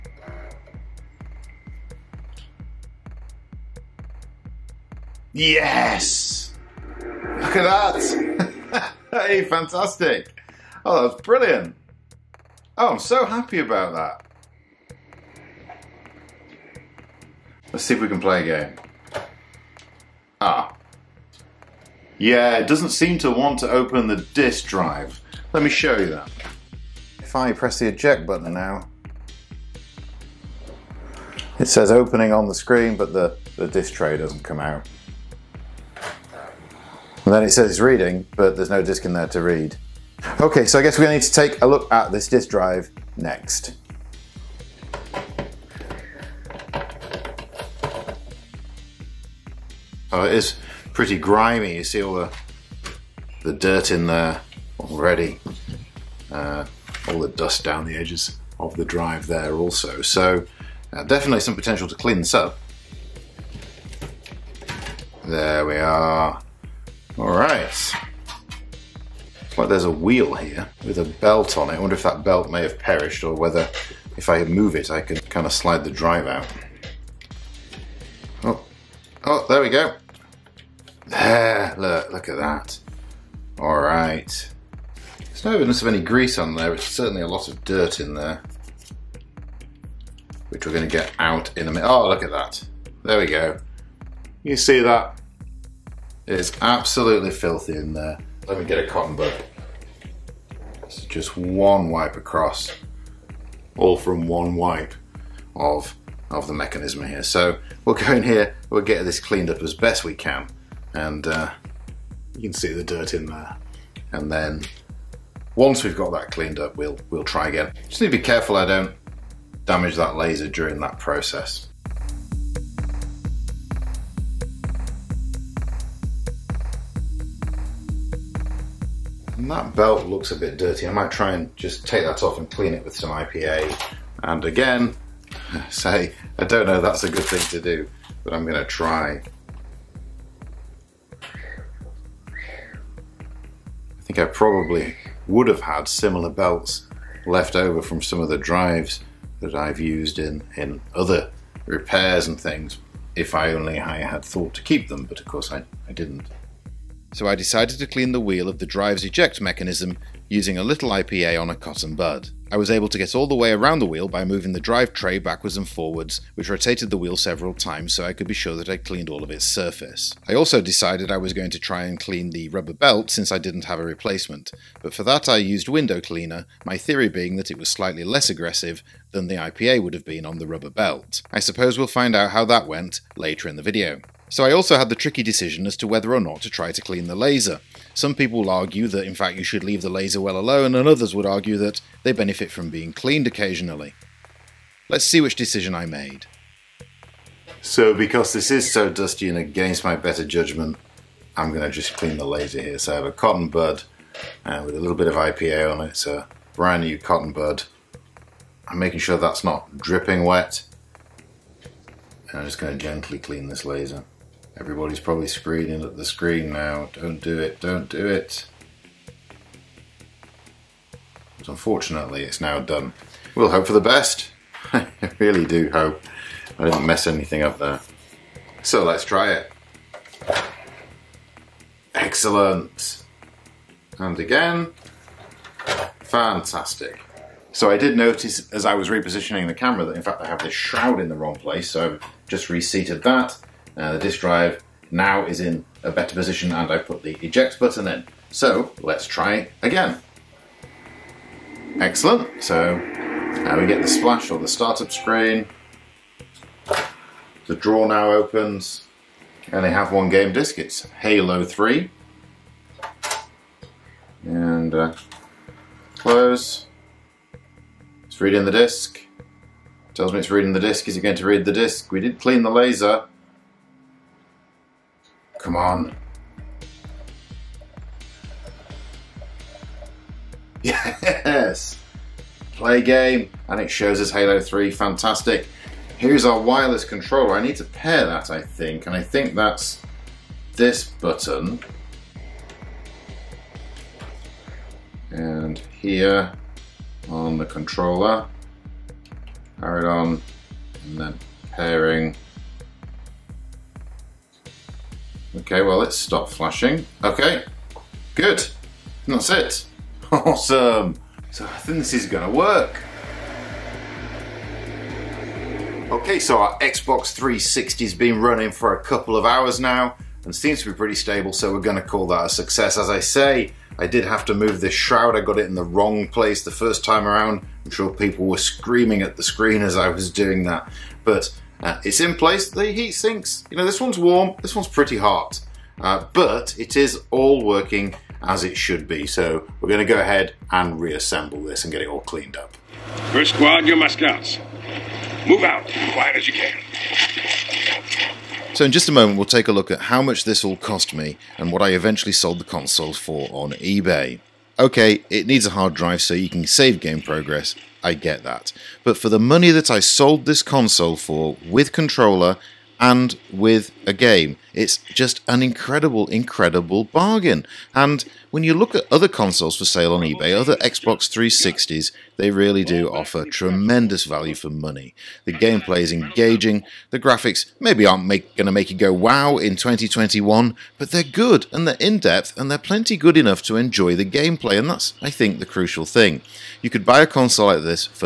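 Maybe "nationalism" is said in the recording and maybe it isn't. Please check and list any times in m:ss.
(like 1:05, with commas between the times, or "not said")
not said.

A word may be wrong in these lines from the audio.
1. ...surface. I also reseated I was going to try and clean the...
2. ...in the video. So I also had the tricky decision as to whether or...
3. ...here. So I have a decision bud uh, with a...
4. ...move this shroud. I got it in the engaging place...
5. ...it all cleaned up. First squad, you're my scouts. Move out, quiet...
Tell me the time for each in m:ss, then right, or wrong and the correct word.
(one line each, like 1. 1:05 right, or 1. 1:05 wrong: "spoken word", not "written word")
1. 2:49 wrong: "decided", not "reseated"
2. 3:03 right
3. 3:22 wrong: "cotton", not "decision"
4. 5:24 wrong: "wrong", not "engaging"
5. 5:41 right.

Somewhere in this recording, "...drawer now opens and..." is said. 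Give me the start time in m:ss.
4:17.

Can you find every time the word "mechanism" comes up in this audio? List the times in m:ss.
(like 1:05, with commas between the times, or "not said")
1:46, 2:39.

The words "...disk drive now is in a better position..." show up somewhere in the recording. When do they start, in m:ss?
4:03.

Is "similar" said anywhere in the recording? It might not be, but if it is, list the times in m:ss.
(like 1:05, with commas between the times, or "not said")
2:25.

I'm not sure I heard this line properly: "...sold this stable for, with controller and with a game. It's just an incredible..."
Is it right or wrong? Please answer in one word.
wrong.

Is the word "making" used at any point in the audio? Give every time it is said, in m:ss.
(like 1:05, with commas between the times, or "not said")
3:28.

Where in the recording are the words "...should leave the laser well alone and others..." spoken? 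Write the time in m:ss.
3:09.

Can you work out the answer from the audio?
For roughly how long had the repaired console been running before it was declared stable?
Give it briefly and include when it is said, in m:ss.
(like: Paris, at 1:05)
a couple of hours, at 5:18.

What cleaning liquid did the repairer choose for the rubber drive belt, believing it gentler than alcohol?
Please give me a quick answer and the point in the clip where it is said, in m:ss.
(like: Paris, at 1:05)
window cleaner, at 2:55.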